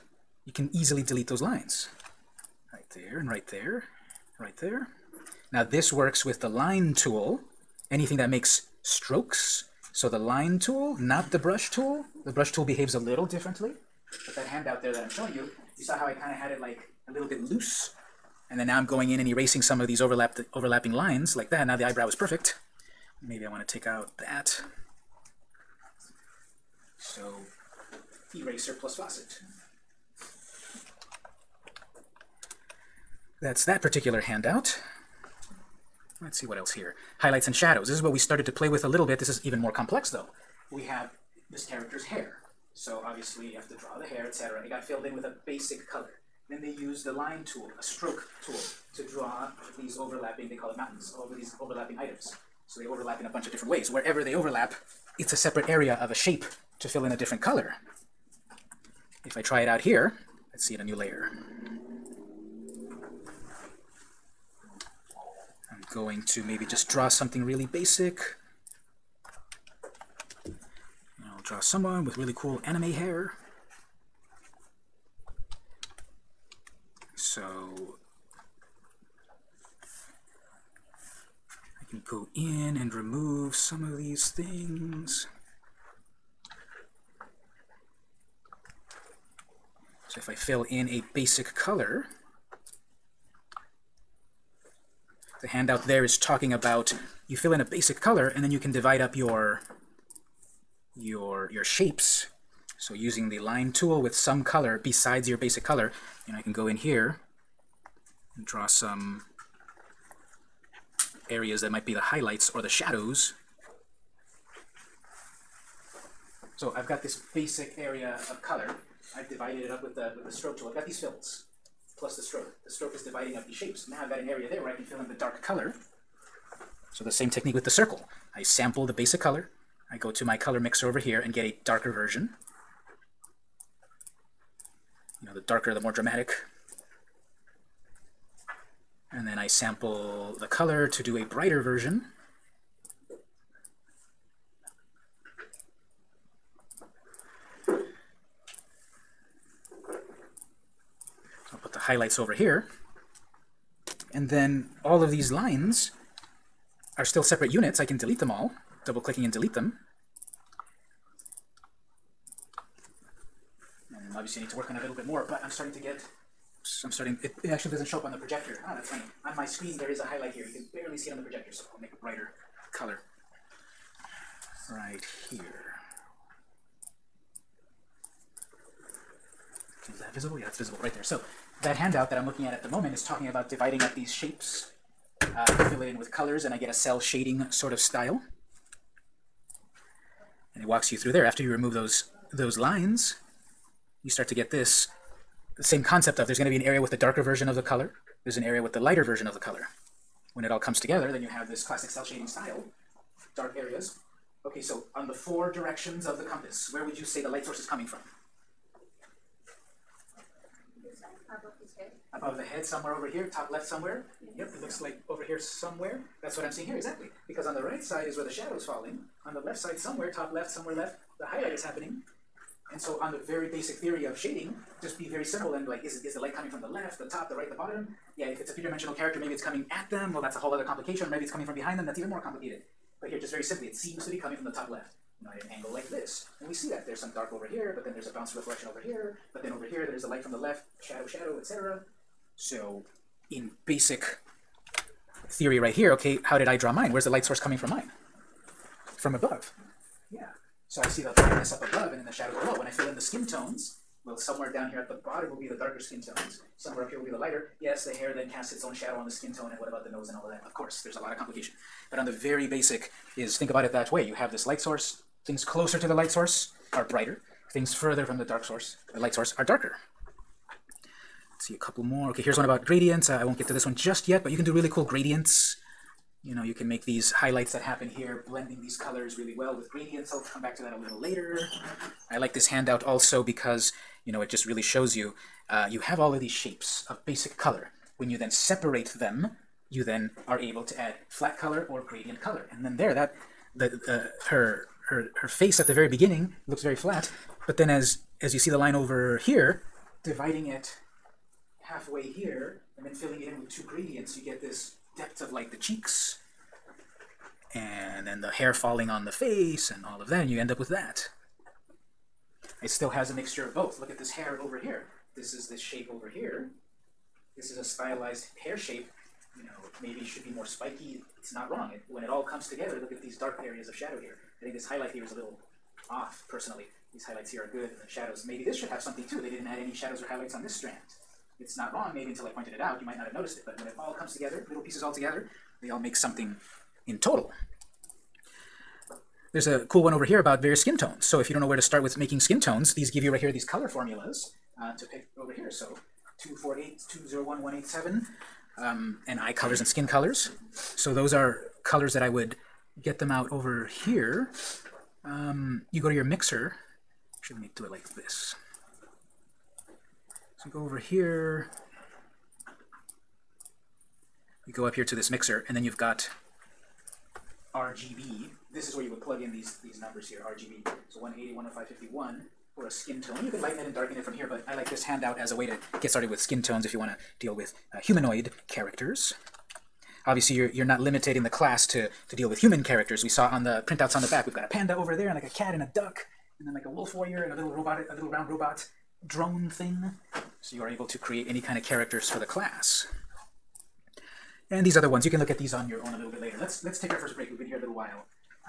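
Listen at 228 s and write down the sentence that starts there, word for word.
Yeah, if it's a three-dimensional character, maybe it's coming at them.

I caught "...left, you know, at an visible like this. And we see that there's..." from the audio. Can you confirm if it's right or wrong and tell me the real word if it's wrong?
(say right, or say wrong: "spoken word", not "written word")
wrong: "angle", not "visible".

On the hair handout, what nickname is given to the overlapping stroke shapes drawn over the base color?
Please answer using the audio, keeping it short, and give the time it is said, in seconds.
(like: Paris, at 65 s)
mountains, at 50 s.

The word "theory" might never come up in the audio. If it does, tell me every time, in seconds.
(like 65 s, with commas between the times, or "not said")
223 s, 245 s.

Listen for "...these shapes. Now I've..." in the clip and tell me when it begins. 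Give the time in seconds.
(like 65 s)
123 s.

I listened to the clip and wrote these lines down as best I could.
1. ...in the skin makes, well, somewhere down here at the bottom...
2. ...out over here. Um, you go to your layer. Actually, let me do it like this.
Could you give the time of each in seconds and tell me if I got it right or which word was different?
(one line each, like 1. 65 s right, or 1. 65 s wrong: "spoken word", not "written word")
1. 252 s wrong: "tones", not "makes"
2. 353 s wrong: "mixer", not "layer".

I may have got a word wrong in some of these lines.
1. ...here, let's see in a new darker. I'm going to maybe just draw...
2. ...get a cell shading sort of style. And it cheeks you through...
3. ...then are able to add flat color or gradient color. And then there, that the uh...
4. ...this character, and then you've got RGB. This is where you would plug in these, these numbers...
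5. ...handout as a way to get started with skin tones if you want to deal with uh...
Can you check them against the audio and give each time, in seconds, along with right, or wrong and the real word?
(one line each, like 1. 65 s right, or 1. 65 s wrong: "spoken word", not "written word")
1. 59 s wrong: "layer", not "darker"
2. 186 s wrong: "walks", not "cheeks"
3. 289 s right
4. 364 s wrong: "mixer", not "character"
5. 374 s right.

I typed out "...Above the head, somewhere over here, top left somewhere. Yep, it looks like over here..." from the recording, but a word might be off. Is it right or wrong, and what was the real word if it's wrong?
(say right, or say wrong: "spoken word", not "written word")
right.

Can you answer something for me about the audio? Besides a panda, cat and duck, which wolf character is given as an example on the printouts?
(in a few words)
wolf warrior.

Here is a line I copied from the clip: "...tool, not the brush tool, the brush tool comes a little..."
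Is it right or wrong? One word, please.
wrong.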